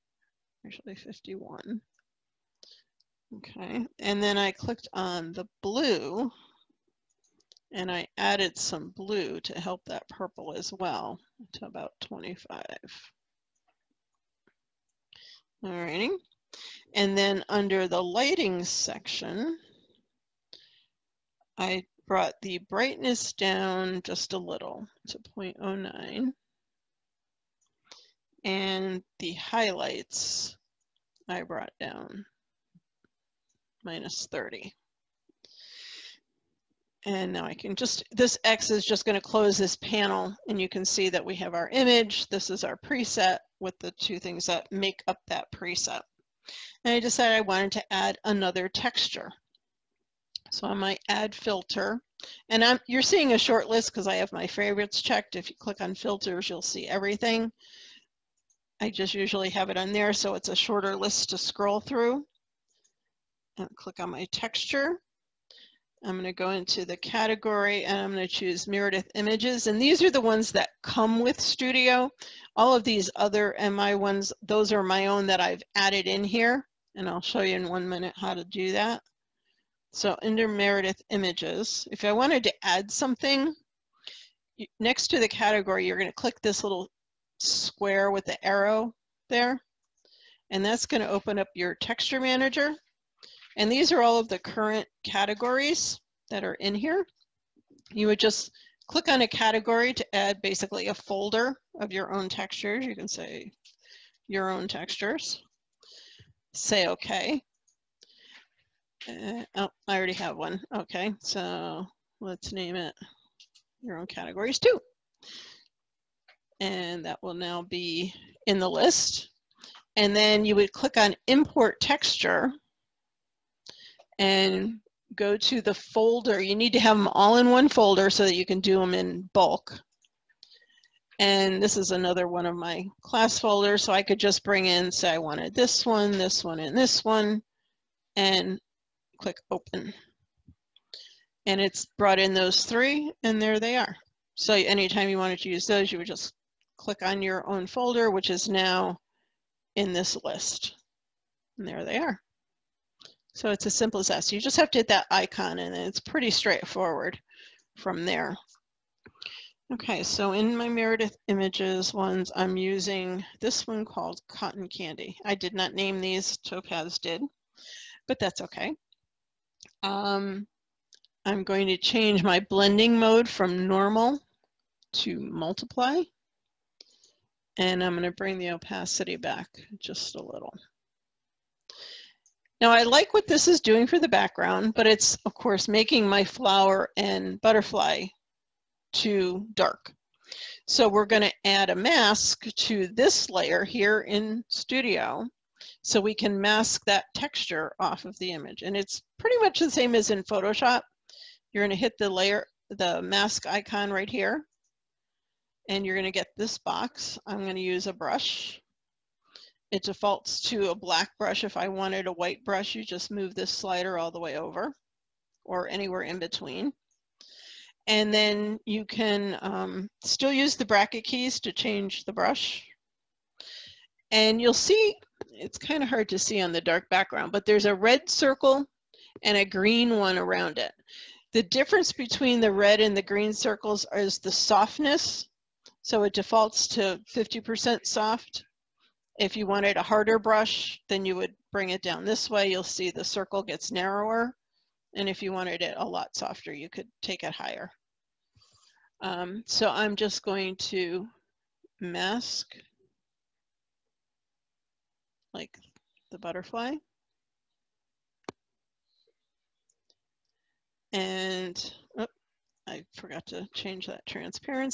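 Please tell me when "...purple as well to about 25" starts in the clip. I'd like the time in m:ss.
0:10.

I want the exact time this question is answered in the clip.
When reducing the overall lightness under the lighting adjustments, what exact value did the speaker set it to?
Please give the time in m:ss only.
0:25.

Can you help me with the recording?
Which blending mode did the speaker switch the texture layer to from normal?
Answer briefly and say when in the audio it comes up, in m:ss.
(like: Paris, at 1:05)
Multiply, at 2:55.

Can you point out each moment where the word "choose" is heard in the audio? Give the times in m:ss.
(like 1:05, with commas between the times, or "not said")
1:08.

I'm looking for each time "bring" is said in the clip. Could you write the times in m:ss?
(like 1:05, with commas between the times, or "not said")
2:14, 2:58, 4:01.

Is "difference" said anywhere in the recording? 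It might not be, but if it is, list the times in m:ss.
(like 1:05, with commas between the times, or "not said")
3:51.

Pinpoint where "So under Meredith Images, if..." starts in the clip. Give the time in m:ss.
1:19.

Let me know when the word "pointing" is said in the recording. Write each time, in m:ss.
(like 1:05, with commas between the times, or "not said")
not said.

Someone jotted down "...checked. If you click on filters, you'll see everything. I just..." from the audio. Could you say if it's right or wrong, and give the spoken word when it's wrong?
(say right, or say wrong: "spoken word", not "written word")
right.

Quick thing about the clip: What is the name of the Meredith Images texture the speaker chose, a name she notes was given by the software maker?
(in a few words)
Cotton Candy.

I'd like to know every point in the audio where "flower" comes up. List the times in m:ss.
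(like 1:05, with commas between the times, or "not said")
3:06.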